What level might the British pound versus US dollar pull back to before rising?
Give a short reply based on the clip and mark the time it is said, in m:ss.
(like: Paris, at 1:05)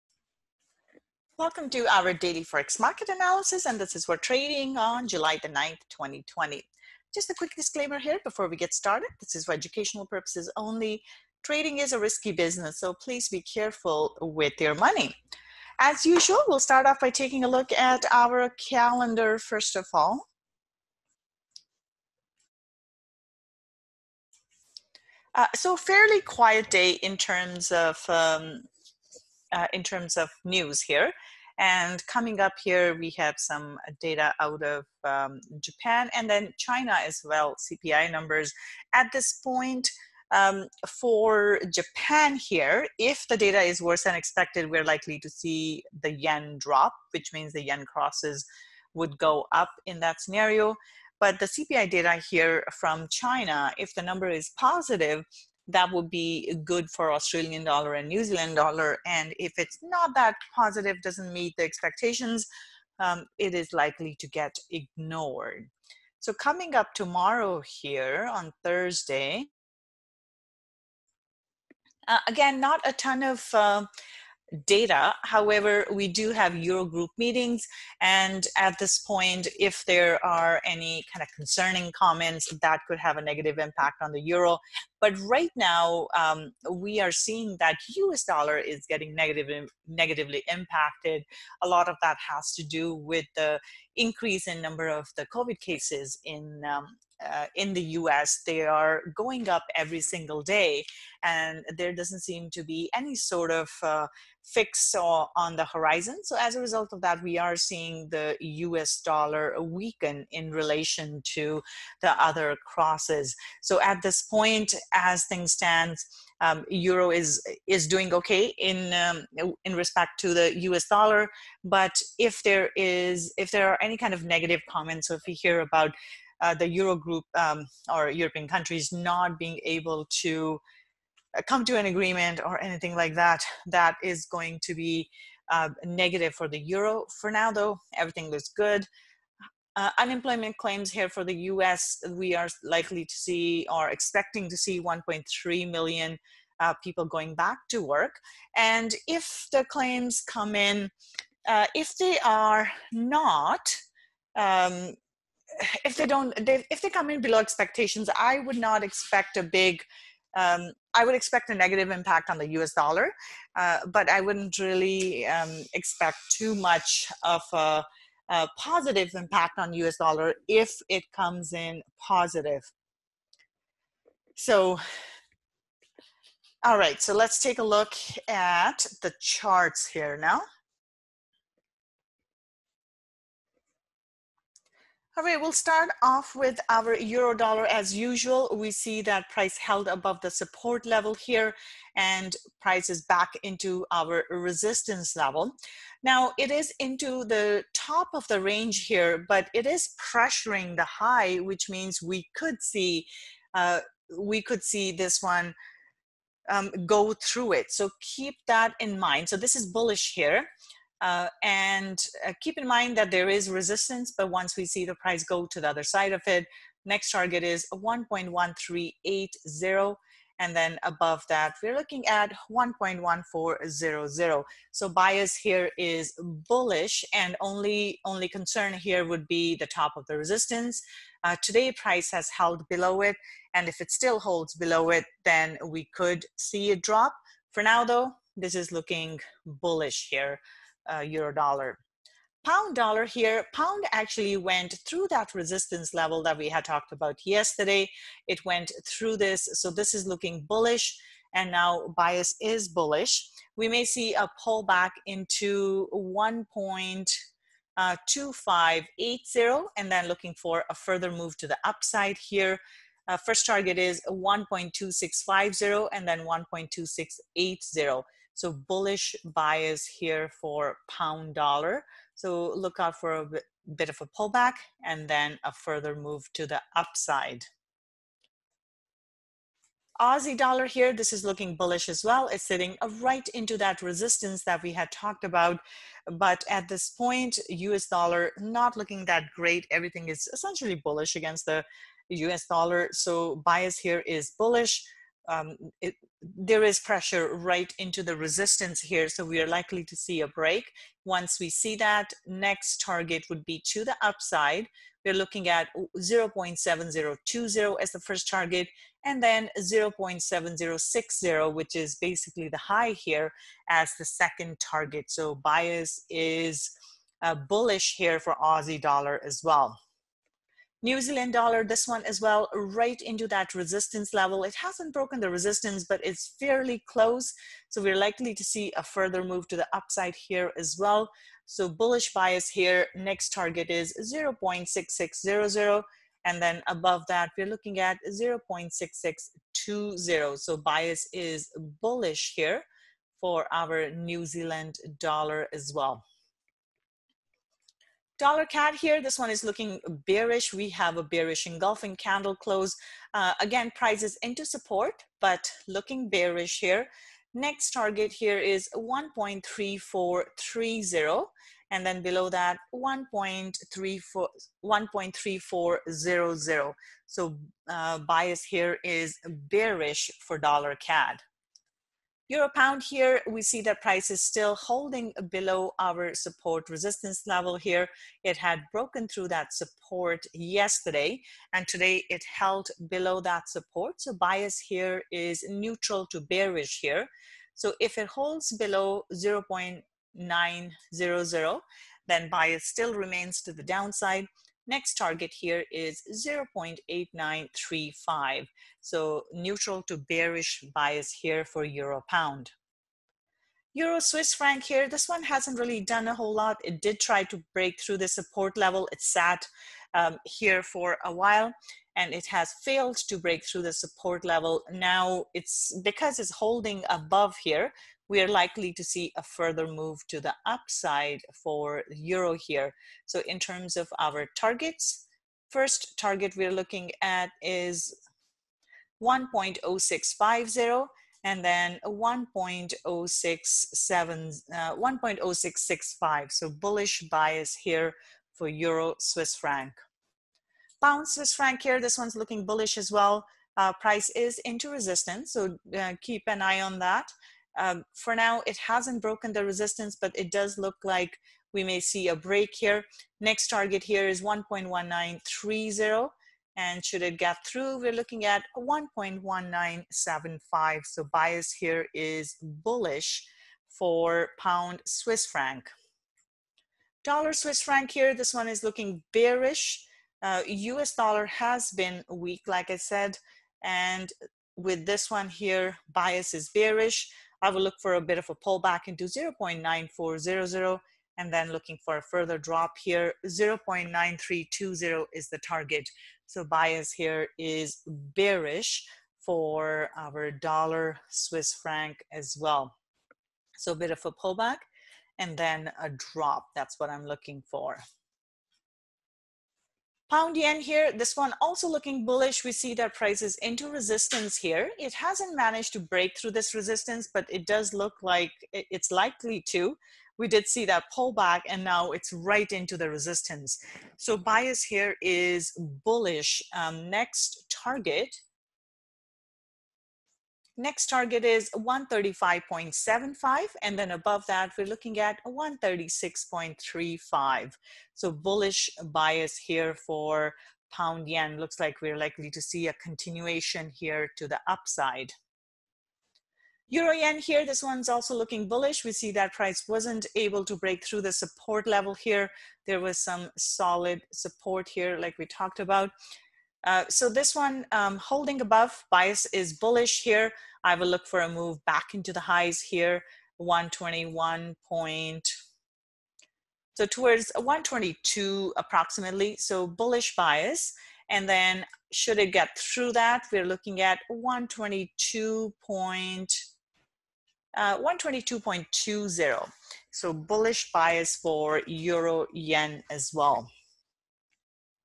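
1.2580, at 4:15.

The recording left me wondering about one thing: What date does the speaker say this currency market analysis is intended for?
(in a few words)
July 9th, 2020.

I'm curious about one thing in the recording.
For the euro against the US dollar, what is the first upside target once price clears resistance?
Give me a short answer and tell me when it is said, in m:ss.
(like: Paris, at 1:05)
1.1380, at 3:37.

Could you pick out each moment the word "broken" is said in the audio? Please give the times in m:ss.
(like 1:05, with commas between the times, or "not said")
5:24, 6:18, 7:29.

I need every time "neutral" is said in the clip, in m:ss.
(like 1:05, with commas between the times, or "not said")
6:25, 6:39.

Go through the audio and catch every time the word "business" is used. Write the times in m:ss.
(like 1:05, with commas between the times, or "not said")
0:12.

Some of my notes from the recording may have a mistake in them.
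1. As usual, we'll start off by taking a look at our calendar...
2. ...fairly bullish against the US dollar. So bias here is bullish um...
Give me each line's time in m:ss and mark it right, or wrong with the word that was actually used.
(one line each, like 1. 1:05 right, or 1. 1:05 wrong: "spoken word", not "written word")
1. 0:15 right
2. 4:50 wrong: "essentially", not "fairly".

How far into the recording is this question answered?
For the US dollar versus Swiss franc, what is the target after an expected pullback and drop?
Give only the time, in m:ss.
8:03.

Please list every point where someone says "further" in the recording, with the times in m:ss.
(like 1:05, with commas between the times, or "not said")
4:20, 4:35, 5:28, 6:59, 8:02.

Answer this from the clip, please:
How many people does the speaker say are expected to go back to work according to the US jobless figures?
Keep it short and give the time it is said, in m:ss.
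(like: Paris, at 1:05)
1.3 million, at 2:24.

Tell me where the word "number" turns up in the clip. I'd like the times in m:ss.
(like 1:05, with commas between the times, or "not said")
0:38, 0:54, 1:34.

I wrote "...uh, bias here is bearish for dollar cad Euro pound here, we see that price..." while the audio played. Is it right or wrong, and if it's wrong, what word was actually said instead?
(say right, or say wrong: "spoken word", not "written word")
right.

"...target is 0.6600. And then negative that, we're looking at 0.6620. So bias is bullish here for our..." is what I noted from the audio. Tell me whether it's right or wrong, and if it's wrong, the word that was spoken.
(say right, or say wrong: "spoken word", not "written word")
wrong: "above", not "negative".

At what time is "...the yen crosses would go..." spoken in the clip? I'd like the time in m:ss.
0:47.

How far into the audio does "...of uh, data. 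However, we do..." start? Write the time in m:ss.
1:13.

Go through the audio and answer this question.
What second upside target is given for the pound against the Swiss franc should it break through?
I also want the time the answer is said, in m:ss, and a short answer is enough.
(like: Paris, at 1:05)
1.1975, at 7:38.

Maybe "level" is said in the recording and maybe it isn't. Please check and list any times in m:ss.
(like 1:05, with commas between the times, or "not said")
3:10, 3:15, 4:05, 5:24, 6:17, 6:48, 6:54, 9:01.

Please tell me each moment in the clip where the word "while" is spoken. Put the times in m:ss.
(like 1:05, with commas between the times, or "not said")
6:51.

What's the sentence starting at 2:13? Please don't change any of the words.
That is going to be uh, negative for the euro.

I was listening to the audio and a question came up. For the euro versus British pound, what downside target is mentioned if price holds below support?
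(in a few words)
0.8935.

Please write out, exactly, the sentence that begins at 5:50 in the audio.
We have a bearish engulfing candle close.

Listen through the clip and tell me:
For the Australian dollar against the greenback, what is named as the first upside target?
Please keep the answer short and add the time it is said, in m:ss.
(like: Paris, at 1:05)
0.7020, at 5:05.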